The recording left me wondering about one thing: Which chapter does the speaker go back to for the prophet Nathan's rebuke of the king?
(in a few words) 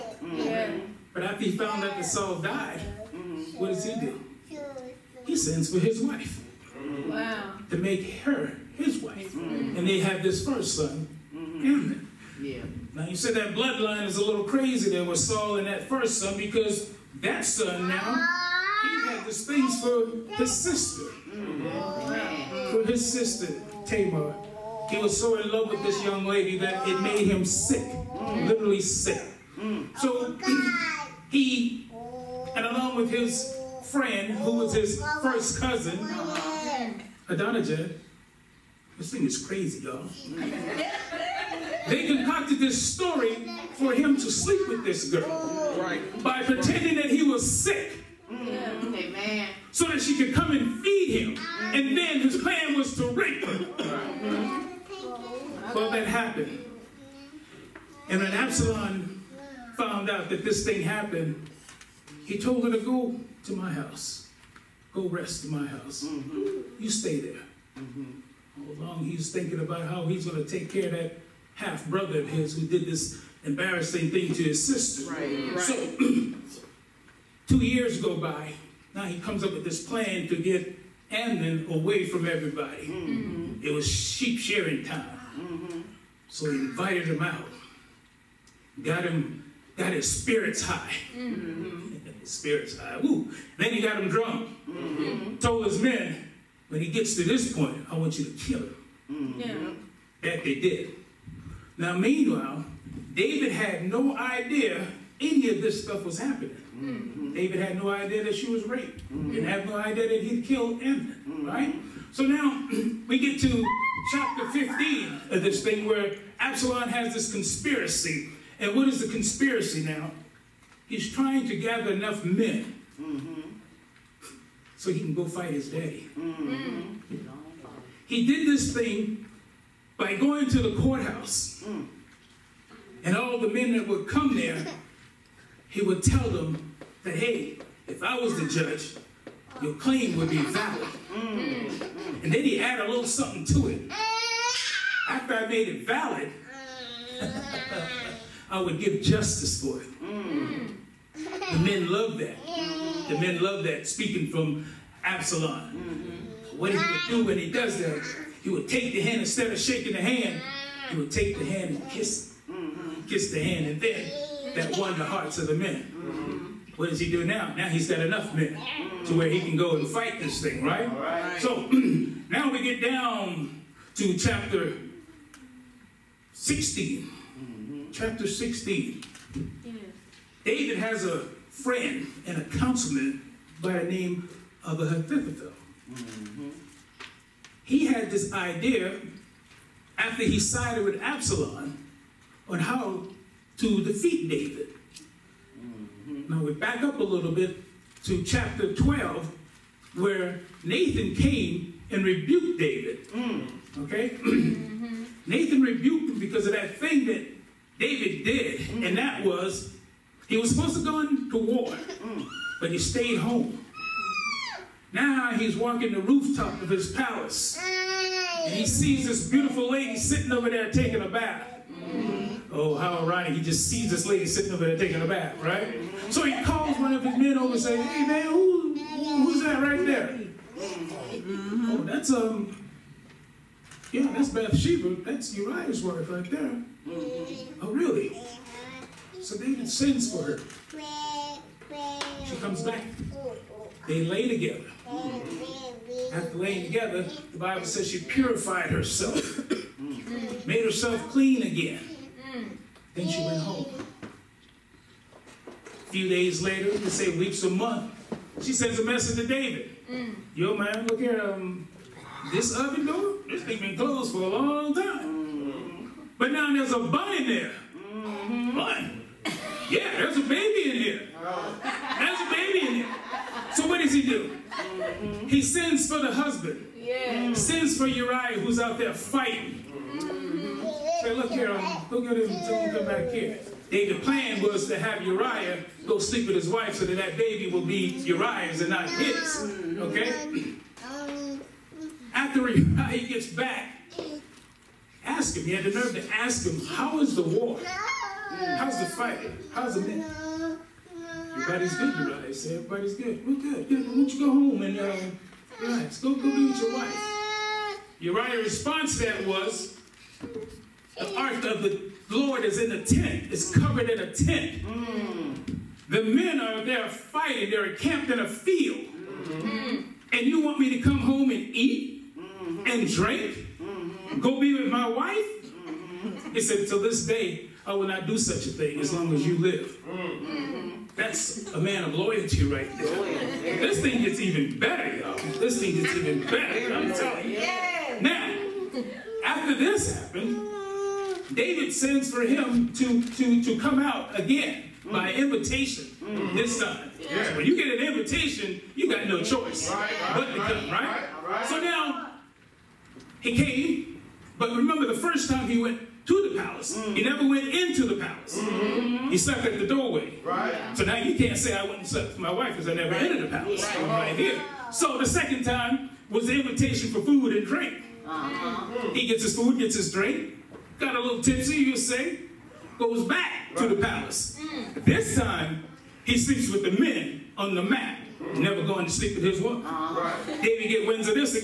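Chapter 12.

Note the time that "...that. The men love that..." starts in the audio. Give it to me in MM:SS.
02:32.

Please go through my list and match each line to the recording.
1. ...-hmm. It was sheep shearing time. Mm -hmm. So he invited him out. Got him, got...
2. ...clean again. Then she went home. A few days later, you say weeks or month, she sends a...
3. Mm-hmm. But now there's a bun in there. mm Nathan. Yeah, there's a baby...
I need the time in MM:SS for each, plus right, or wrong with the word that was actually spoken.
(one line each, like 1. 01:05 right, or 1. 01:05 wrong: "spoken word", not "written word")
1. 01:23 right
2. 04:11 right
3. 04:24 wrong: "Bun", not "Nathan".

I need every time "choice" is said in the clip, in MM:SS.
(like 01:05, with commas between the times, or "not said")
05:49.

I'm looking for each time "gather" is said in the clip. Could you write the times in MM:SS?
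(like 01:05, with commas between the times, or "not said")
02:01.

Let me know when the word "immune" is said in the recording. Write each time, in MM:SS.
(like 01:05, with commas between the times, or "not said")
not said.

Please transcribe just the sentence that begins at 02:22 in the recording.
And then he added a little something to it.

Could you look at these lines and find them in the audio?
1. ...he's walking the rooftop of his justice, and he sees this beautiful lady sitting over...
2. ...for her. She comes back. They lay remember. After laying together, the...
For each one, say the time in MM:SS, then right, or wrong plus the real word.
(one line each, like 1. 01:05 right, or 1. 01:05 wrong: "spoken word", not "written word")
1. 03:35 wrong: "palace", not "justice"
2. 04:00 wrong: "together", not "remember".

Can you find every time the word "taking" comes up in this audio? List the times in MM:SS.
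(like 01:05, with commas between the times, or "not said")
03:40, 03:44.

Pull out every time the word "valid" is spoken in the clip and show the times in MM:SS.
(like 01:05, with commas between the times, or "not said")
02:20, 02:25.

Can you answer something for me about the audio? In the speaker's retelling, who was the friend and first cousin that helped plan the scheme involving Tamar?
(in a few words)
Adonijah.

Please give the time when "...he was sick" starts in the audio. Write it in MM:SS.
00:47.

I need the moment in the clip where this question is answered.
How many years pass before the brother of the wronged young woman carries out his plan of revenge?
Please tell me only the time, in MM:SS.
01:17.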